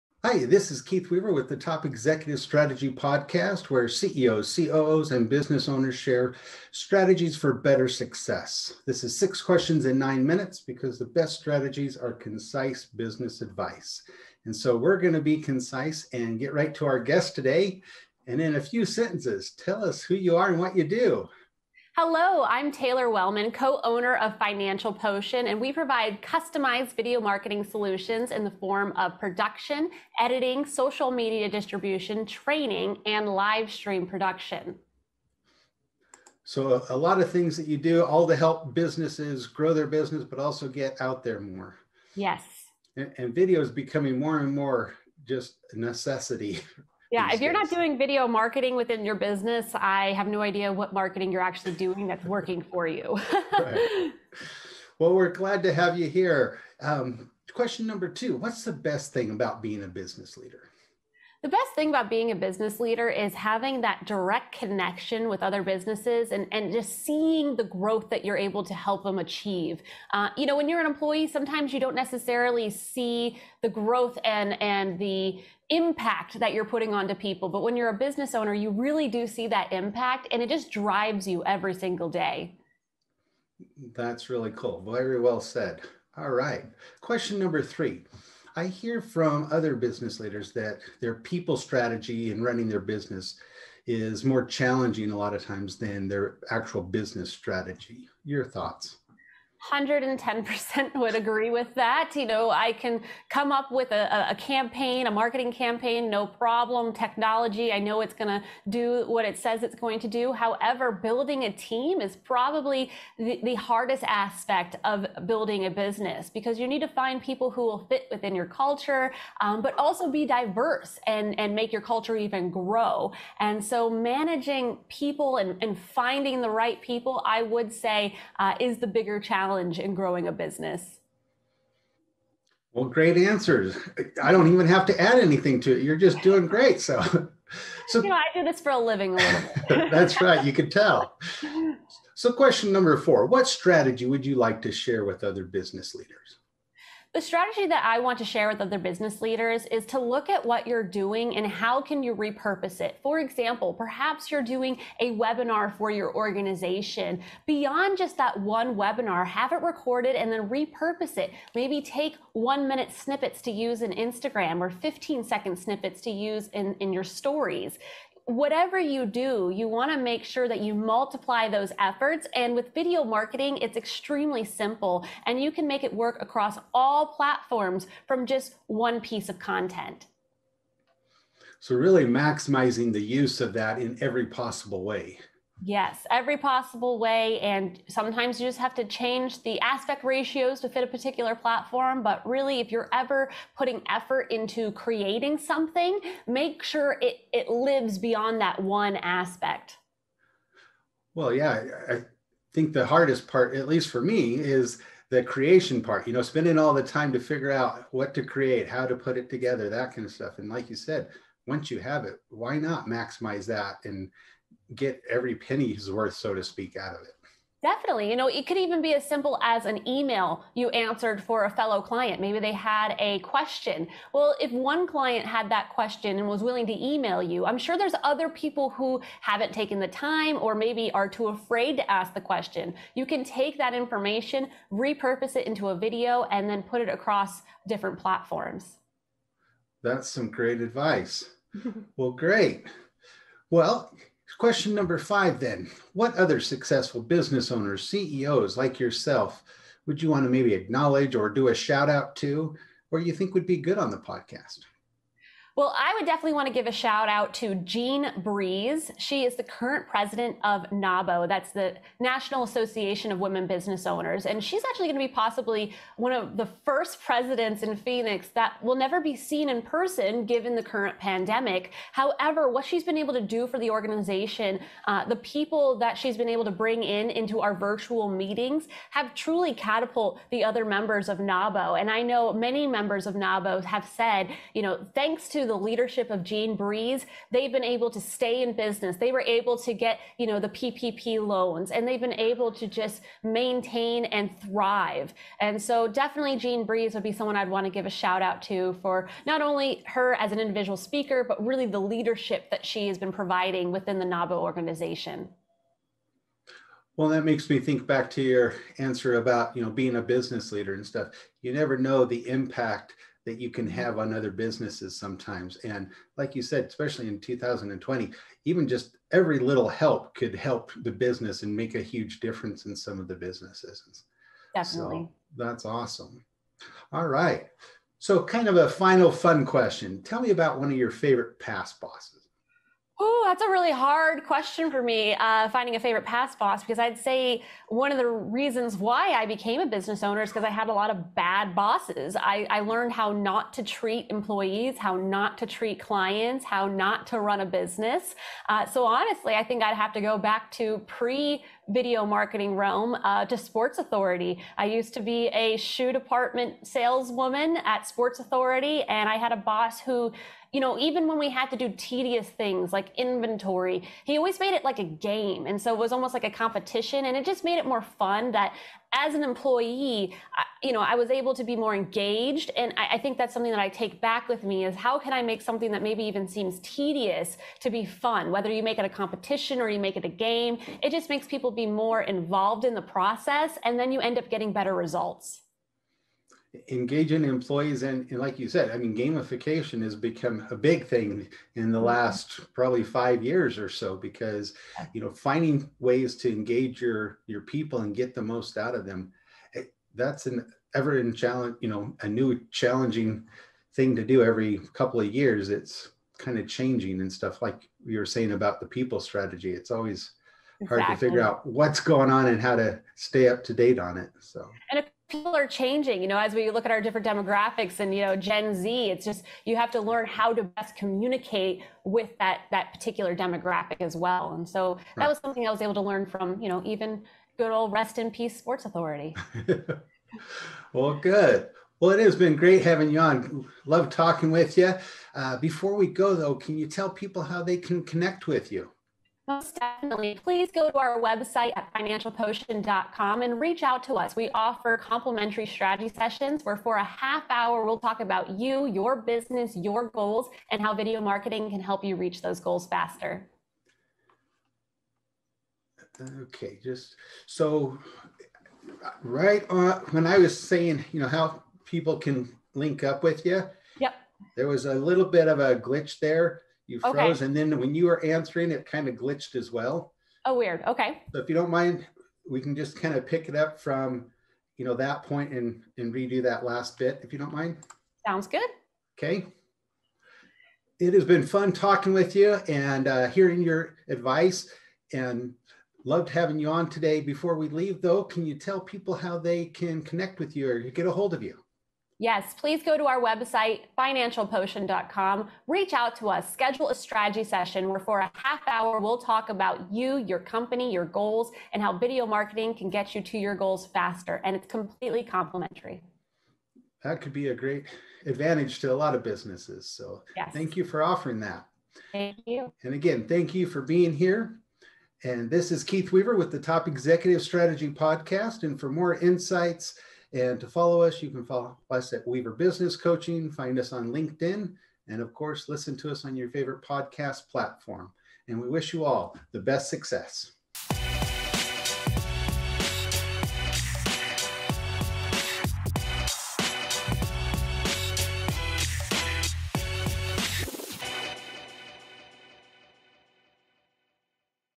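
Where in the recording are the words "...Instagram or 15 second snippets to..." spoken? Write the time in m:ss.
2:43.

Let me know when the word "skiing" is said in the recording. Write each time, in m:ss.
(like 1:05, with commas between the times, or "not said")
not said.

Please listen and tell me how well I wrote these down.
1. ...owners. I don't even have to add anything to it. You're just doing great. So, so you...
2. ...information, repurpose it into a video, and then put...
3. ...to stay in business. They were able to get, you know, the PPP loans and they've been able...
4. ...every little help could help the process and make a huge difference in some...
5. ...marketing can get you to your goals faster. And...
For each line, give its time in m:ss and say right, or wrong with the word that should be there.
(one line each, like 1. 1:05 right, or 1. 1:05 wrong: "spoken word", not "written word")
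1. 2:13 wrong: "answers", not "owners"
2. 3:53 right
3. 4:47 right
4. 5:19 wrong: "business", not "process"
5. 8:22 right.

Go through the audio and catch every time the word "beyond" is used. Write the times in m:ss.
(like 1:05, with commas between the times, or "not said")
2:37, 3:17.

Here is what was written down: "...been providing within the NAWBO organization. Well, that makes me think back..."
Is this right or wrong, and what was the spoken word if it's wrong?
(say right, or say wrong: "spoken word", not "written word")
right.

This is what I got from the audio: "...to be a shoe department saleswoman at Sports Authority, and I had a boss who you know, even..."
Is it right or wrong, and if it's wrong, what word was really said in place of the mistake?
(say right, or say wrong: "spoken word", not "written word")
right.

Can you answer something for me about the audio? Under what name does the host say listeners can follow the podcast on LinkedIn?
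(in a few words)
Weaver Business Coaching.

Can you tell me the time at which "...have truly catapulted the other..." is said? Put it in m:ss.
4:38.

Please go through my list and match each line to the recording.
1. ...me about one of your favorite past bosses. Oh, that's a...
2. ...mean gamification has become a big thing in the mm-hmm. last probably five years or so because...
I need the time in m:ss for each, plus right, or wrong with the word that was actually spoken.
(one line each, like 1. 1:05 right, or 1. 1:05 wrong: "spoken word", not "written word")
1. 5:30 right
2. 6:28 right.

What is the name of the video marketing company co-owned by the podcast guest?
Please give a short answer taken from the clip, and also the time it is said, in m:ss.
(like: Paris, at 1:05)
Financial Potion, at 0:24.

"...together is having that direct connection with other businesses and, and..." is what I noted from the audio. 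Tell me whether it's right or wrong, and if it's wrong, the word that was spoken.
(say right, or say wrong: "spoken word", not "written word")
wrong: "leader", not "together".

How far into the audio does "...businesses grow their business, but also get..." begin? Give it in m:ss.
0:38.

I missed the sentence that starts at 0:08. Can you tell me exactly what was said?
This is six questions in nine minutes because the best strategies are concise business advice.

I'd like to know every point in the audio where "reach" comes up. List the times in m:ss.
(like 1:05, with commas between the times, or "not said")
7:23, 7:31, 8:15.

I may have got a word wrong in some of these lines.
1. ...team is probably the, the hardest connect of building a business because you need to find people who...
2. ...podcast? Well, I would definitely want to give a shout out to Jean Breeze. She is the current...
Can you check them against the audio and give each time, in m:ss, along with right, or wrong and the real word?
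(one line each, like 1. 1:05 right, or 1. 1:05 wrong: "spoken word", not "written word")
1. 1:51 wrong: "aspect", not "connect"
2. 4:13 right.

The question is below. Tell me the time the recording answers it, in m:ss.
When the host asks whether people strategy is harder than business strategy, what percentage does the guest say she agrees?
1:39.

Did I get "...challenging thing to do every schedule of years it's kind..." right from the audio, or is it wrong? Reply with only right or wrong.
wrong.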